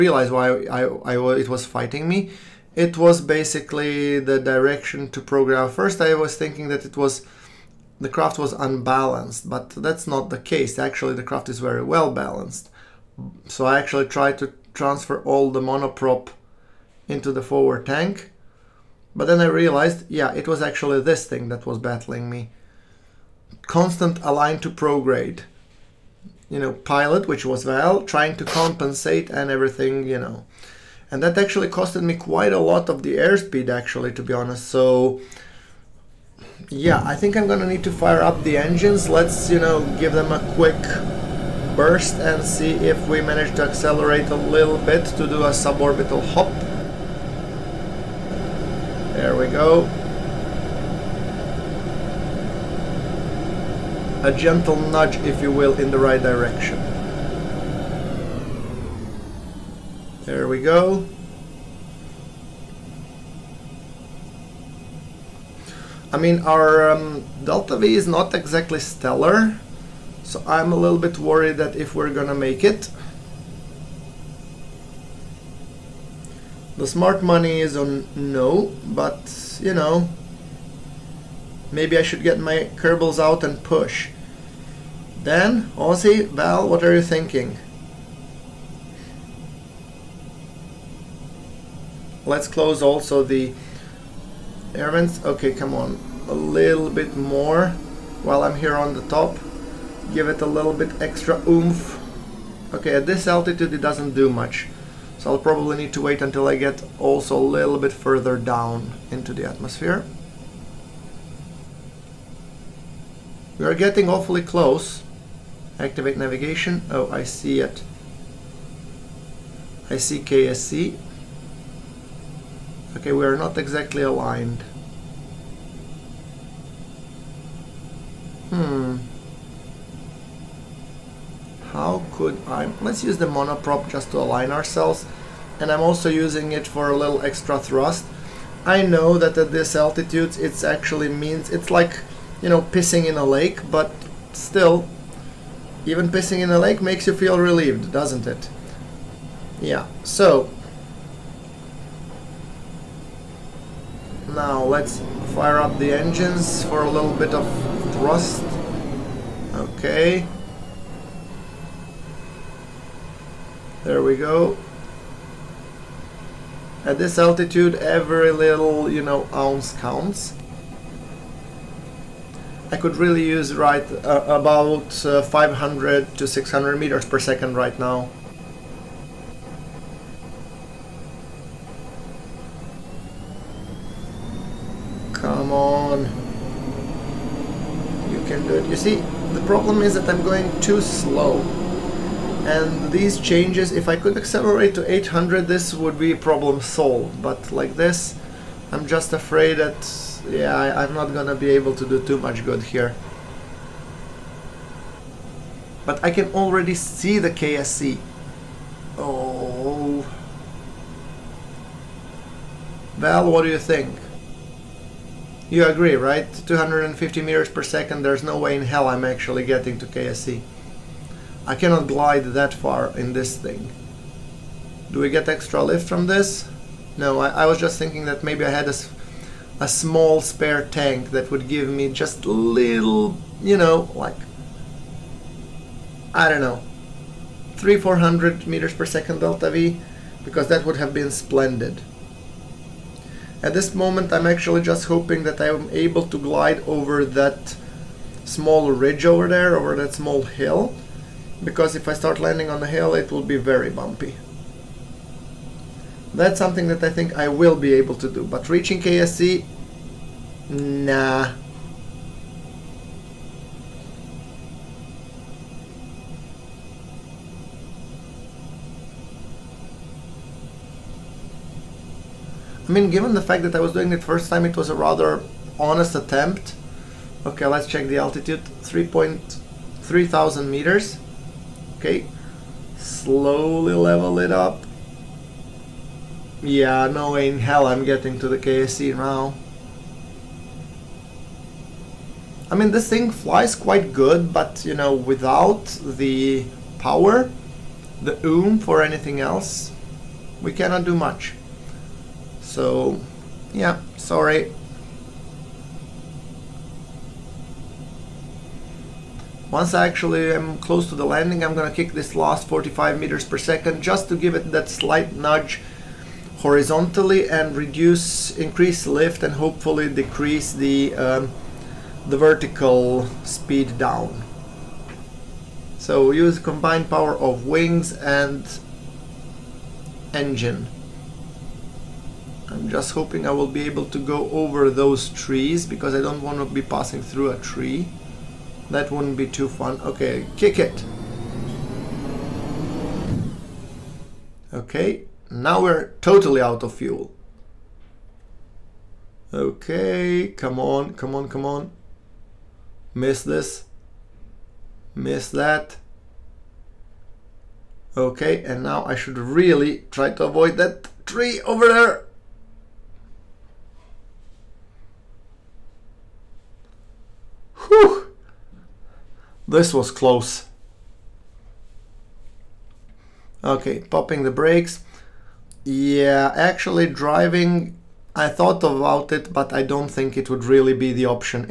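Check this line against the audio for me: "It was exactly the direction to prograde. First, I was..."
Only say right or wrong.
wrong.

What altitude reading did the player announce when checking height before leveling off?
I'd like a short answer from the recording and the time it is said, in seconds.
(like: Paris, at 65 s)
3.3 thousand meters, at 278 s.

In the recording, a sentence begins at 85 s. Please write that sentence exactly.
Then, Aussie, Val, what are you thinking?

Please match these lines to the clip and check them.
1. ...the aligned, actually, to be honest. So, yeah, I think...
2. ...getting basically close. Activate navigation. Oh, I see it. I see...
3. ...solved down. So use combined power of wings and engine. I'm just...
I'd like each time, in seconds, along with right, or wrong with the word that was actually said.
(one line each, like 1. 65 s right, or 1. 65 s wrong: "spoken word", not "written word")
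1. 33 s wrong: "airspeed", not "aligned"
2. 113 s wrong: "awfully", not "basically"
3. 323 s wrong: "speed", not "solved".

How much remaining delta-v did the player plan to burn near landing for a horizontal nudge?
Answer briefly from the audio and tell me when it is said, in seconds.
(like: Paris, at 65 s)
45 meters per second, at 312 s.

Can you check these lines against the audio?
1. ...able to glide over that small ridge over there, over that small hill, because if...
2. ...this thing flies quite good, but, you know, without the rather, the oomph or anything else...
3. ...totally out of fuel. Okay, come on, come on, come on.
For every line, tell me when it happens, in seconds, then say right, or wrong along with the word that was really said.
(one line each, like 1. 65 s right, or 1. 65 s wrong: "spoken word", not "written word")
1. 245 s right
2. 292 s wrong: "power", not "rather"
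3. 346 s right.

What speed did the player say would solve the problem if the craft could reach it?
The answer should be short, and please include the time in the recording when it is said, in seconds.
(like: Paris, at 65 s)
800, at 194 s.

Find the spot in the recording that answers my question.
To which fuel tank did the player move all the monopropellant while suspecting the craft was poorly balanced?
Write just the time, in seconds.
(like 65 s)
17 s.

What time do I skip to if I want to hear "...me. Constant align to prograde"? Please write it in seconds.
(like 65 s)
22 s.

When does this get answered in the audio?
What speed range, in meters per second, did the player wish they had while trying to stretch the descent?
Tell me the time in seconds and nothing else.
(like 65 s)
175 s.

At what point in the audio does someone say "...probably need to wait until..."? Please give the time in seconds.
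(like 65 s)
105 s.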